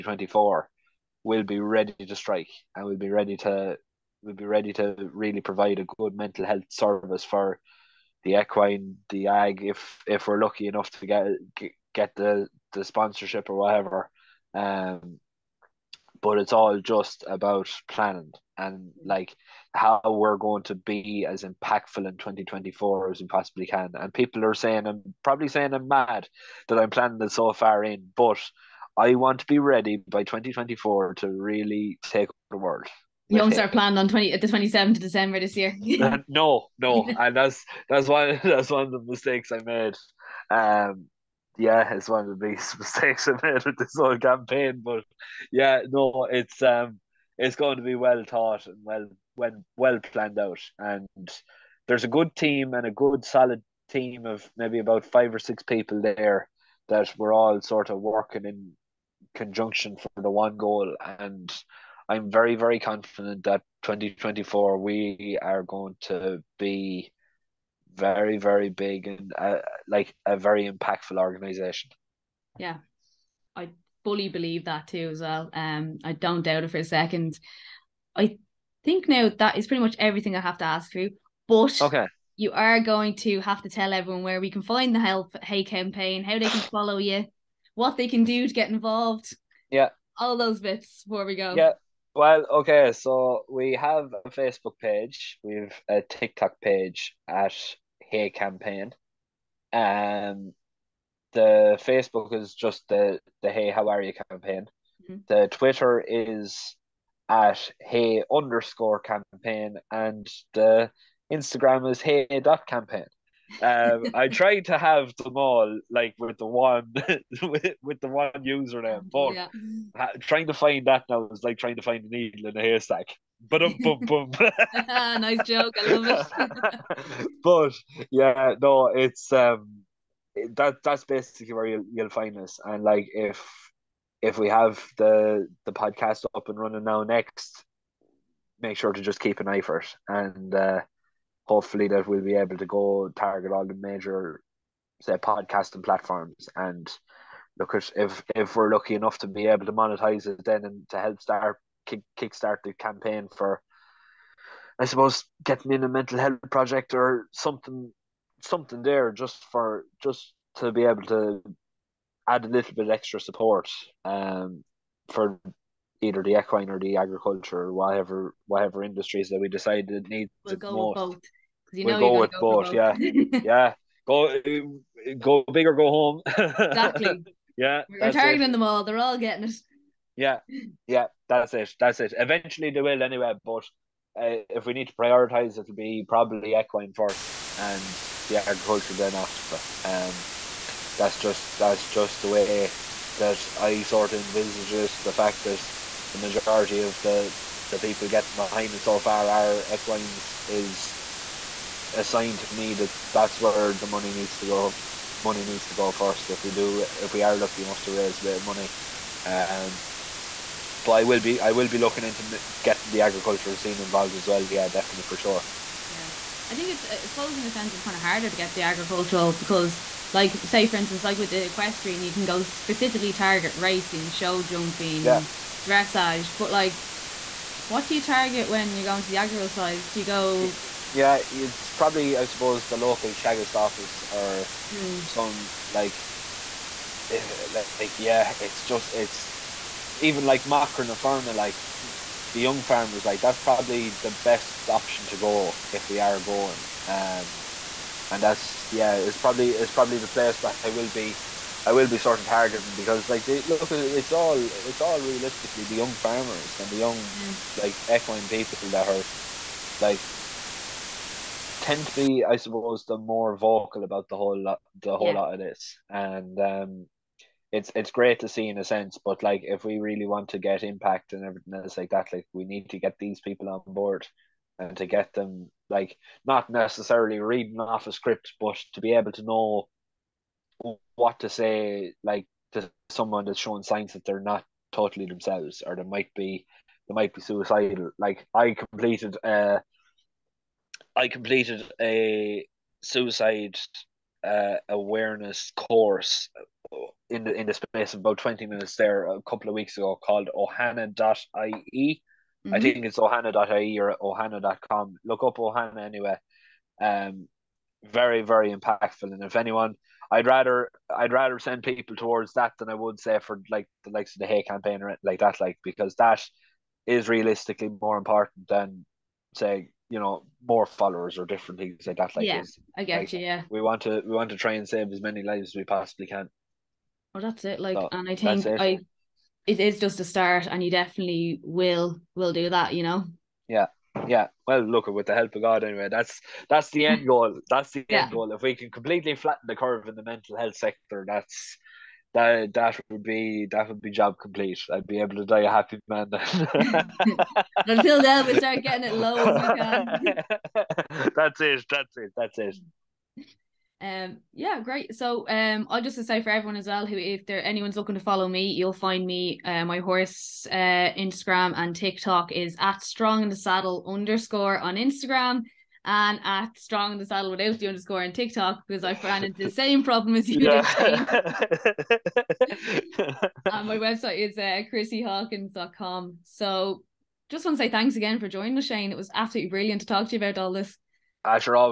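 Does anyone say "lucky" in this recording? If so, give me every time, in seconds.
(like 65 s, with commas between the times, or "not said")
10 s, 148 s, 207 s.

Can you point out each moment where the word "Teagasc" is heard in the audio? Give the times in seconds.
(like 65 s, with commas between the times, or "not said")
233 s.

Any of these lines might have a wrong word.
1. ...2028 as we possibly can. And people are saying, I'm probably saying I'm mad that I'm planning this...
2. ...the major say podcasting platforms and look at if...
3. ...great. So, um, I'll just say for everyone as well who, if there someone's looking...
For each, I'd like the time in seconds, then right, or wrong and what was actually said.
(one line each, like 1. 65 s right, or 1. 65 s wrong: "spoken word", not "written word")
1. 22 s wrong: "2024", not "2028"
2. 143 s right
3. 354 s wrong: "anyone", not "someone".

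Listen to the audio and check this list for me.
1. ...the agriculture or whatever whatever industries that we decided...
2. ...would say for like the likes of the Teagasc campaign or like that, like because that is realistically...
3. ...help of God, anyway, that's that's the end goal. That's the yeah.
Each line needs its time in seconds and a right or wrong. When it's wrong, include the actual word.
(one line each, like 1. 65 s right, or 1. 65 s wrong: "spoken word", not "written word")
1. 166 s right
2. 312 s wrong: "Hay", not "Teagasc"
3. 335 s right.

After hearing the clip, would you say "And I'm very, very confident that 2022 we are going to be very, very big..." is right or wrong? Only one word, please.
wrong.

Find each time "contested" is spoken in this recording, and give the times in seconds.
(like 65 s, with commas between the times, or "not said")
not said.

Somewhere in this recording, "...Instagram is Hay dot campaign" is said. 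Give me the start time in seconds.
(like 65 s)
111 s.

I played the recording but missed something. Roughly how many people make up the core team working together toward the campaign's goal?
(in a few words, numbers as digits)
5 or 6.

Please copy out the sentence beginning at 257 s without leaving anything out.
like equine people that are like tend to be, I suppose, the more vocal about the whole lot, the whole yeah.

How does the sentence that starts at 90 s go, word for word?
All those bits before we go.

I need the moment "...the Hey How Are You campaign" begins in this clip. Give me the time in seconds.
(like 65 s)
103 s.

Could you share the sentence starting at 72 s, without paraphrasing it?
Yeah, I fully believe that too as well.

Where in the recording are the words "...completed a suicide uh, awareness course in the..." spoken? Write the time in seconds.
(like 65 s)
291 s.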